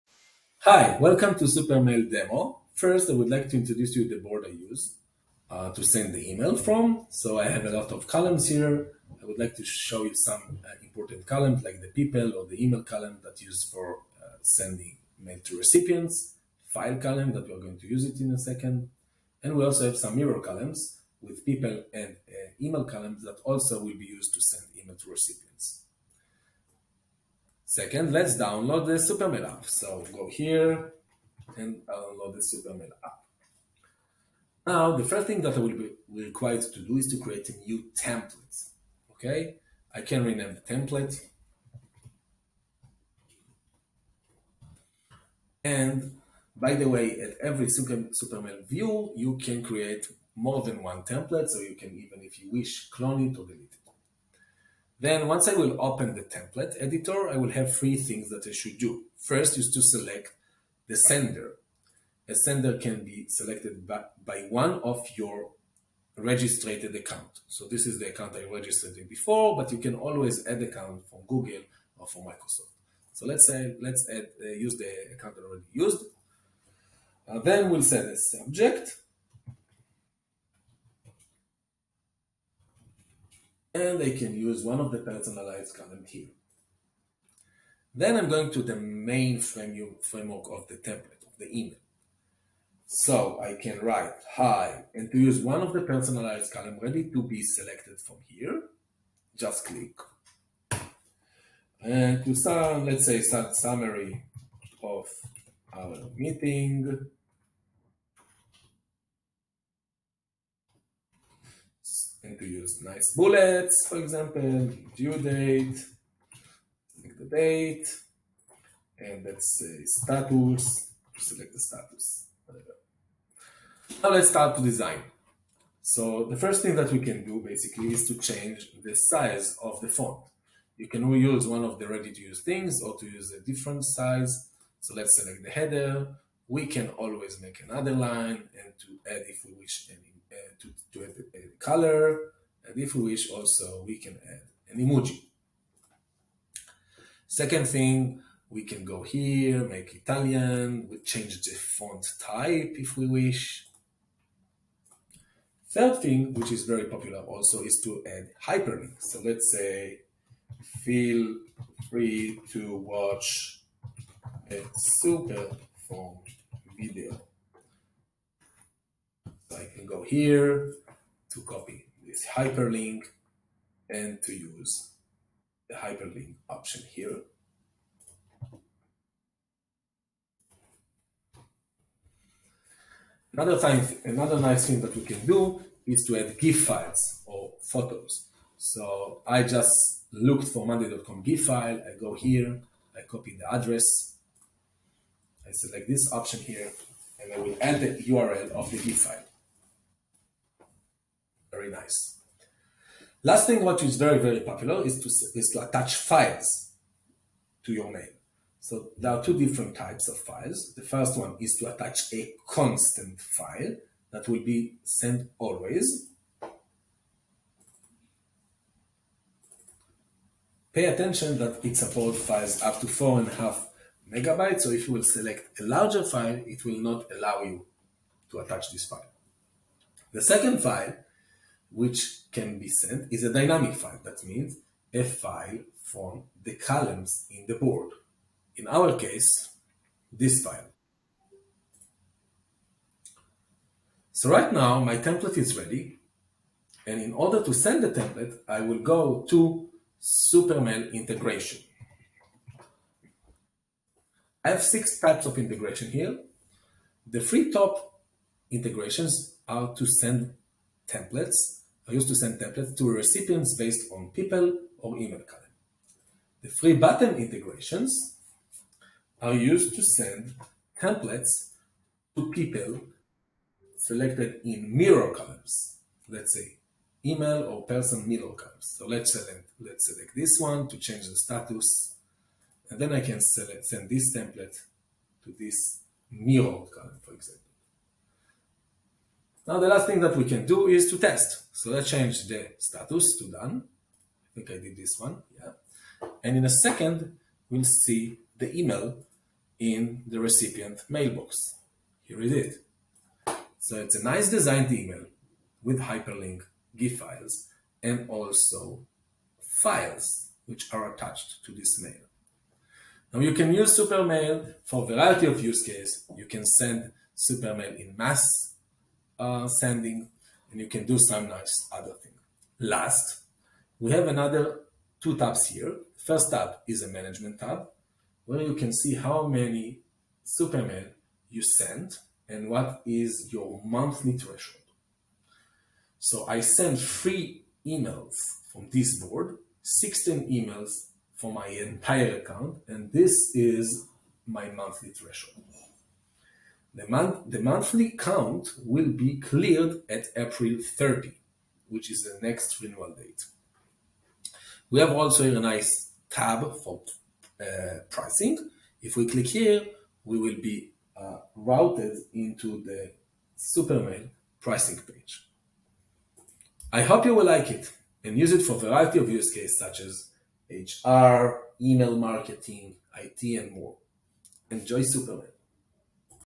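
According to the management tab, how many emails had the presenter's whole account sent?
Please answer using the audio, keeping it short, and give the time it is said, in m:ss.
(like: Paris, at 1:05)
16, at 5:39.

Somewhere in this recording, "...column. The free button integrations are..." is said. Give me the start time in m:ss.
4:25.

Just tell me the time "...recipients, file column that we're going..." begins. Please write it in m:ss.
0:15.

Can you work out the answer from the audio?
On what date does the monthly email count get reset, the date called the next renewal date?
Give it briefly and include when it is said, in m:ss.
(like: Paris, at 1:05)
April 30, at 5:50.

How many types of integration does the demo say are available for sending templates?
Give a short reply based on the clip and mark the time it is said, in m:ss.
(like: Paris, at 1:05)
6, at 4:14.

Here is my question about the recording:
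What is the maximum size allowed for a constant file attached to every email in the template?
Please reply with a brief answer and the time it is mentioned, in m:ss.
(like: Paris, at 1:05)
4.5 megabytes, at 3:42.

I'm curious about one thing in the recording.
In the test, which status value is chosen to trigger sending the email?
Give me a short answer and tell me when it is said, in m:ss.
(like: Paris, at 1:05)
done, at 4:53.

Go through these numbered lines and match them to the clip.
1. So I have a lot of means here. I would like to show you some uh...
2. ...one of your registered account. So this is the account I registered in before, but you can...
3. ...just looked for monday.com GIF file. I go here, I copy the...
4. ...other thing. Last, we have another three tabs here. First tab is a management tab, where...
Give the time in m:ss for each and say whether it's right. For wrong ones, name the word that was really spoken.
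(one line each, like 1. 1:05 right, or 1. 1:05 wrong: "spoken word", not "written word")
1. 0:07 wrong: "columns", not "means"
2. 1:04 right
3. 3:09 right
4. 5:21 wrong: "two", not "three".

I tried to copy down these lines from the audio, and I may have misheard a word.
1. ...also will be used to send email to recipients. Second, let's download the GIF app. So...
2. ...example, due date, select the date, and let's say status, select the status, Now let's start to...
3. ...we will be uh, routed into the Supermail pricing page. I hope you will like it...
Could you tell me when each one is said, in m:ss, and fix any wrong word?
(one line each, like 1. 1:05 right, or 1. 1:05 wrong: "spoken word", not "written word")
1. 0:23 wrong: "Supermail", not "GIF"
2. 1:53 right
3. 6:00 right.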